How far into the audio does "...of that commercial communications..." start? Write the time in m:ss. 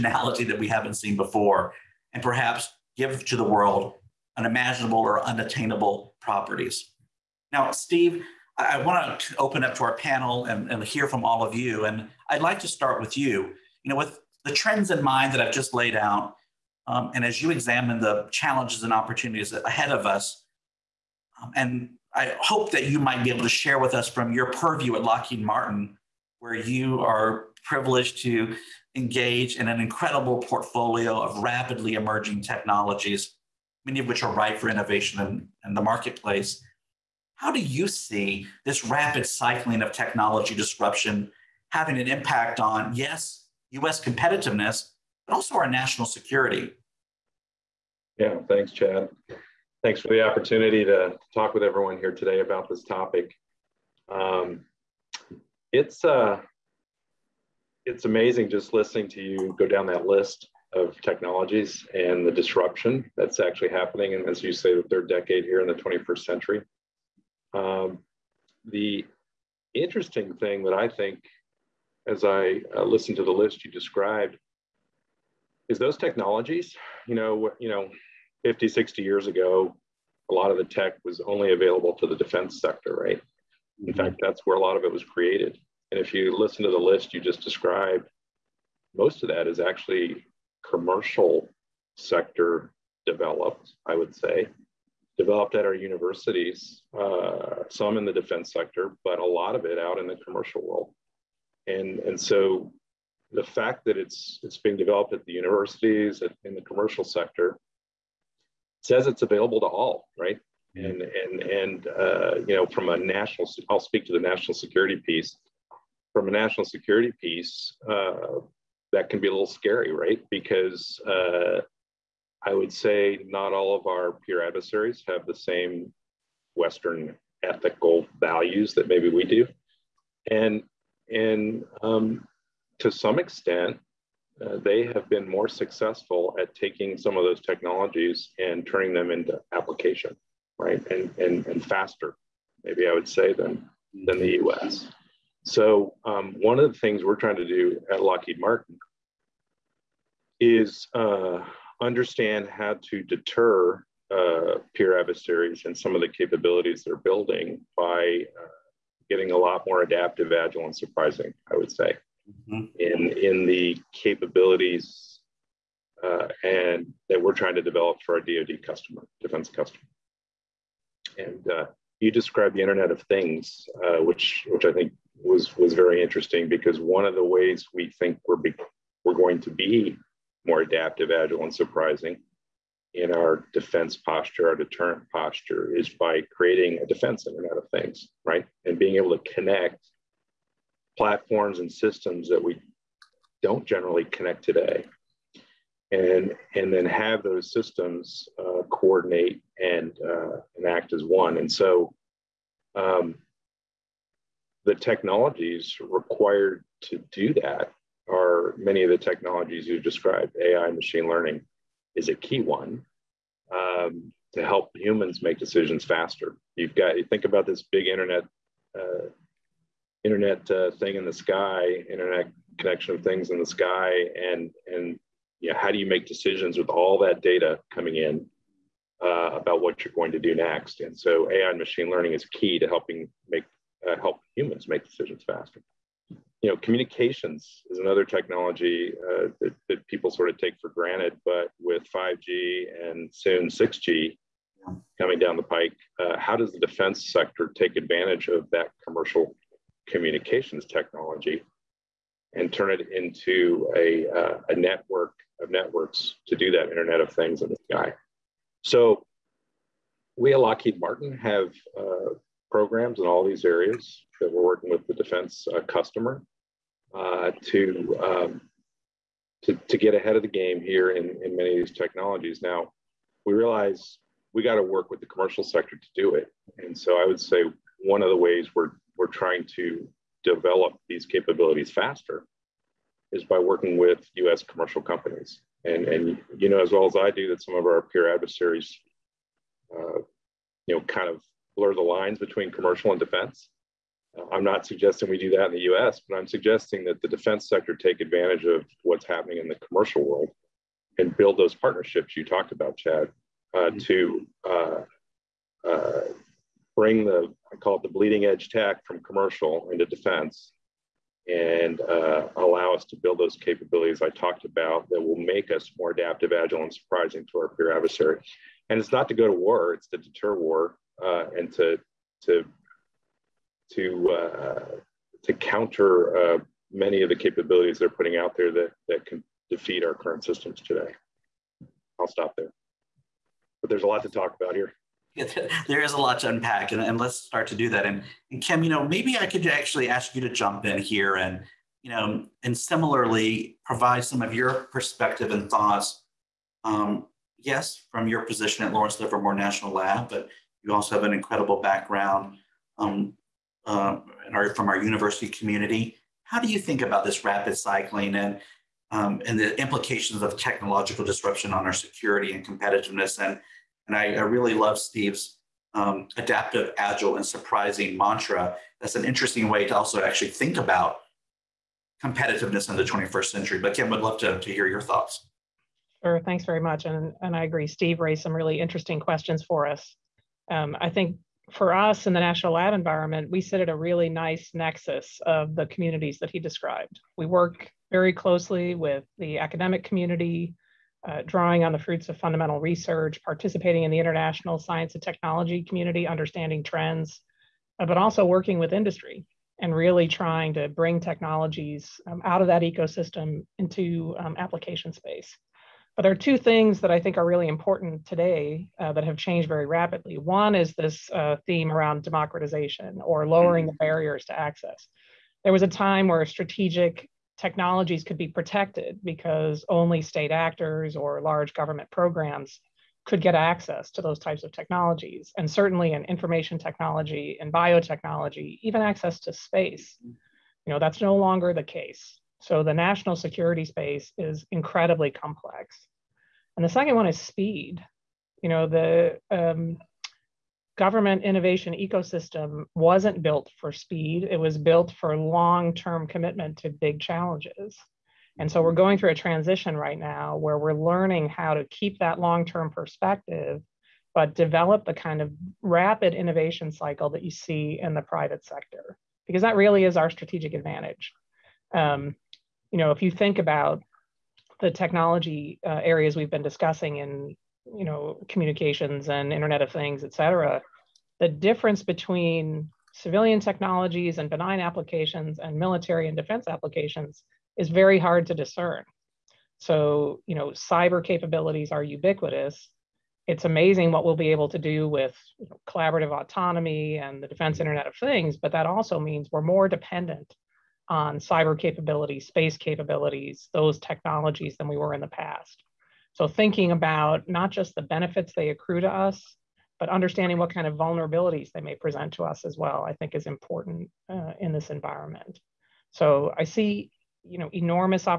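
4:08.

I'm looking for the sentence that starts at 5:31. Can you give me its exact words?
I'll stop there, but there's a lot to talk about here.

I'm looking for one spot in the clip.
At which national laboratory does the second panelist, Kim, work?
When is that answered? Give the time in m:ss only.
5:48.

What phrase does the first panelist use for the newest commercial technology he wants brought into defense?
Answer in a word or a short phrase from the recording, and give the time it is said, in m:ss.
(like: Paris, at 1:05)
bleeding edge tech, at 5:07.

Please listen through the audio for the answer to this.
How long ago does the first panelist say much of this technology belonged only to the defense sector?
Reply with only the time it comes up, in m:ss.
1:18.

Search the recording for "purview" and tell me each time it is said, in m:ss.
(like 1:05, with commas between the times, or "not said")
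0:24.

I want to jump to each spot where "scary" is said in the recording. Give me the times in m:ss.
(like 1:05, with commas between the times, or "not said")
1:59.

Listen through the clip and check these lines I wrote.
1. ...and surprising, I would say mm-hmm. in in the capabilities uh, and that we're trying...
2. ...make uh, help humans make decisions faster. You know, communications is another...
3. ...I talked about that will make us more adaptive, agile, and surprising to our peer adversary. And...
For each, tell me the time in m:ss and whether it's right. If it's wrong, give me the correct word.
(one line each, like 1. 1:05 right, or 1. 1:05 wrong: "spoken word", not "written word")
1. 2:40 right
2. 3:53 right
3. 5:14 right.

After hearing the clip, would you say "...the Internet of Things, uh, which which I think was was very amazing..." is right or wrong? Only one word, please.
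wrong.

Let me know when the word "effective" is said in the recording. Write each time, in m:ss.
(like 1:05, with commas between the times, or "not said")
not said.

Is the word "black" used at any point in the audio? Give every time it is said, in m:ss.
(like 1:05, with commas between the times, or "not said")
not said.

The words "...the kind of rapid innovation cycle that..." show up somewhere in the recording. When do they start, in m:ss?
7:34.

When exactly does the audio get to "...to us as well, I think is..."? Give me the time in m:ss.
8:22.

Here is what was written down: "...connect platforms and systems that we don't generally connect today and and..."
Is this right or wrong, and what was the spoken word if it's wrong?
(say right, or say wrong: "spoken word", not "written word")
right.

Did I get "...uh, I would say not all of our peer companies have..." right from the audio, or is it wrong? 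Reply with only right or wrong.
wrong.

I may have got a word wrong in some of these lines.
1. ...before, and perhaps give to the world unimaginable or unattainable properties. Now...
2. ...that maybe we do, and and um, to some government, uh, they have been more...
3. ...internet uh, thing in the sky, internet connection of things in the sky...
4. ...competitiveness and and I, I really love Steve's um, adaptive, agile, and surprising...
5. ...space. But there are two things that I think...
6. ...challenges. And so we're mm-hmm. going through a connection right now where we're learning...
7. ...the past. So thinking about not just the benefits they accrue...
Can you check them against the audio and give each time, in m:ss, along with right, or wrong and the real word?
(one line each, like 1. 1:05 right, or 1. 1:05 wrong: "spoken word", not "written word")
1. 0:01 right
2. 2:08 wrong: "extent", not "government"
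3. 3:40 right
4. 6:02 right
5. 6:44 right
6. 7:26 wrong: "transition", not "connection"
7. 8:15 right.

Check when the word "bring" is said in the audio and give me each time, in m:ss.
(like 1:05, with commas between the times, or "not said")
5:06, 6:40.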